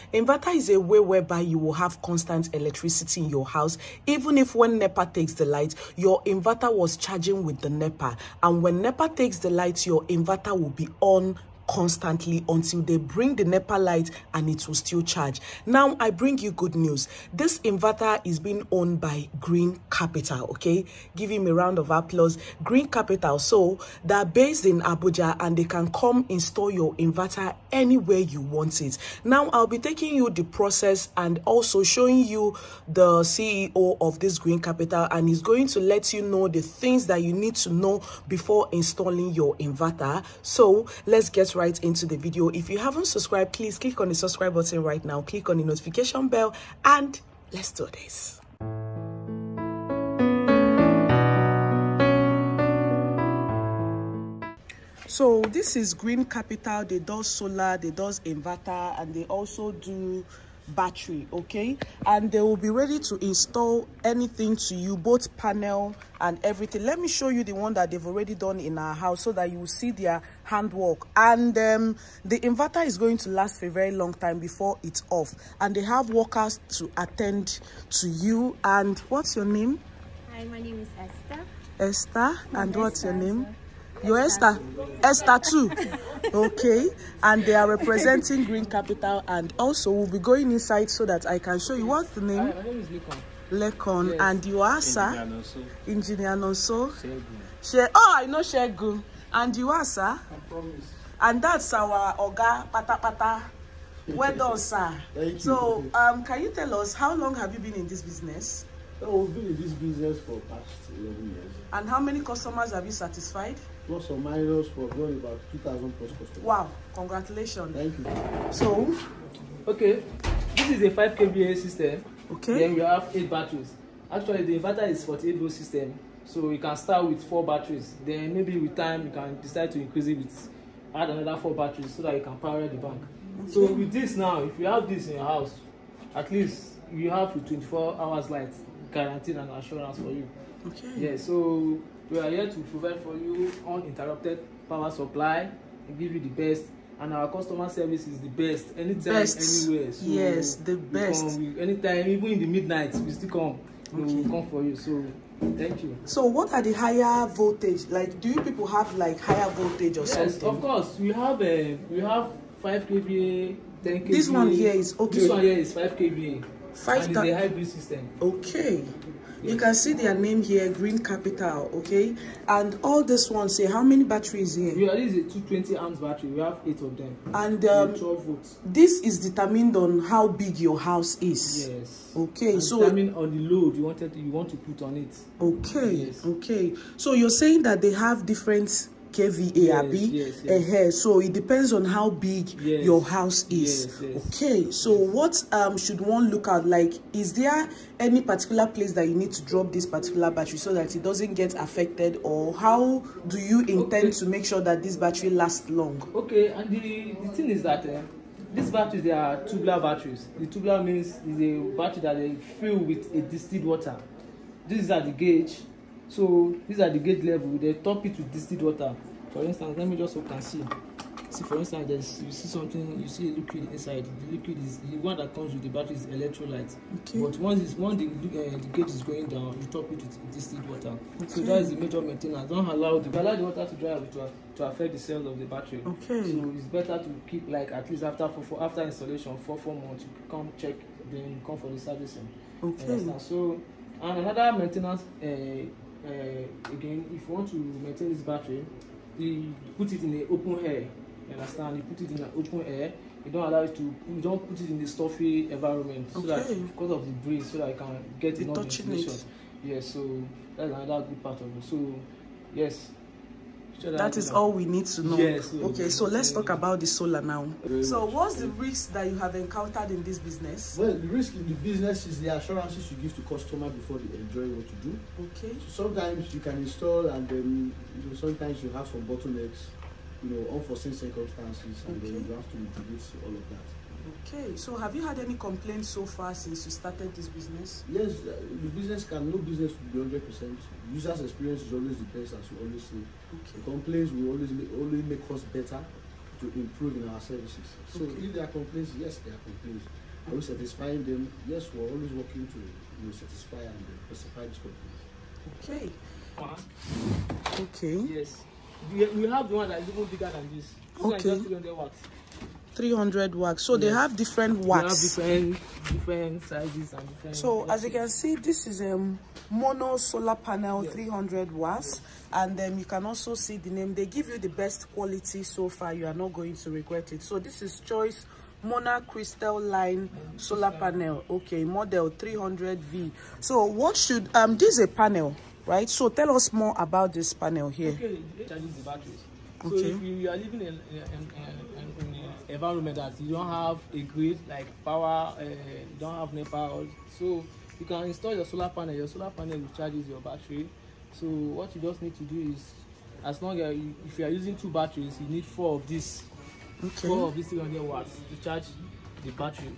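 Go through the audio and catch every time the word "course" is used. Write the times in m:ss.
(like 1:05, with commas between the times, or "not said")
2:40.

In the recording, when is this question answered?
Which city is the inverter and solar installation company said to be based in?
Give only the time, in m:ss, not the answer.
0:24.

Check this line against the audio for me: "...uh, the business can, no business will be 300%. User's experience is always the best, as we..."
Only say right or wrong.
wrong.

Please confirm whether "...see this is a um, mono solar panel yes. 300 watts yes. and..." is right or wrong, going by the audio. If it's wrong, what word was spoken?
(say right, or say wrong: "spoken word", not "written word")
right.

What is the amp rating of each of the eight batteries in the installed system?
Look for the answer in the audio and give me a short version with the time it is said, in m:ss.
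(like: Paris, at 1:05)
220 amps, at 2:55.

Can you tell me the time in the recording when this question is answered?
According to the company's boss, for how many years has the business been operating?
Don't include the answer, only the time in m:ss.
1:50.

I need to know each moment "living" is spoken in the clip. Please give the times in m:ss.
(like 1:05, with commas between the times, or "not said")
5:40.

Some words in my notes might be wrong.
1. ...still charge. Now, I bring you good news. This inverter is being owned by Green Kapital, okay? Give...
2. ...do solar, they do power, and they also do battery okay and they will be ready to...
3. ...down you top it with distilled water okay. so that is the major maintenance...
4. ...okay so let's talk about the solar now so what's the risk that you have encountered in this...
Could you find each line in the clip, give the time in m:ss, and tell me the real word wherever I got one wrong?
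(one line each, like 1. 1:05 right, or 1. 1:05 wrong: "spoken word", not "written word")
1. 0:14 right
2. 0:56 wrong: "inverter", not "power"
3. 3:49 right
4. 4:25 right.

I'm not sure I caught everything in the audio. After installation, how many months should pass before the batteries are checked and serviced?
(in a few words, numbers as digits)
4 months.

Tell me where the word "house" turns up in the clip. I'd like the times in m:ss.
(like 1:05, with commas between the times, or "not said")
0:03, 1:08, 2:15, 3:00, 3:13.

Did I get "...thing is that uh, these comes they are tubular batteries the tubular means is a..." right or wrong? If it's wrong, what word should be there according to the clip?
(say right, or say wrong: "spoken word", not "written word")
wrong: "batteries", not "comes".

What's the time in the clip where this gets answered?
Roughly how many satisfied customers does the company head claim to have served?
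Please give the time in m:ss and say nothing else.
1:55.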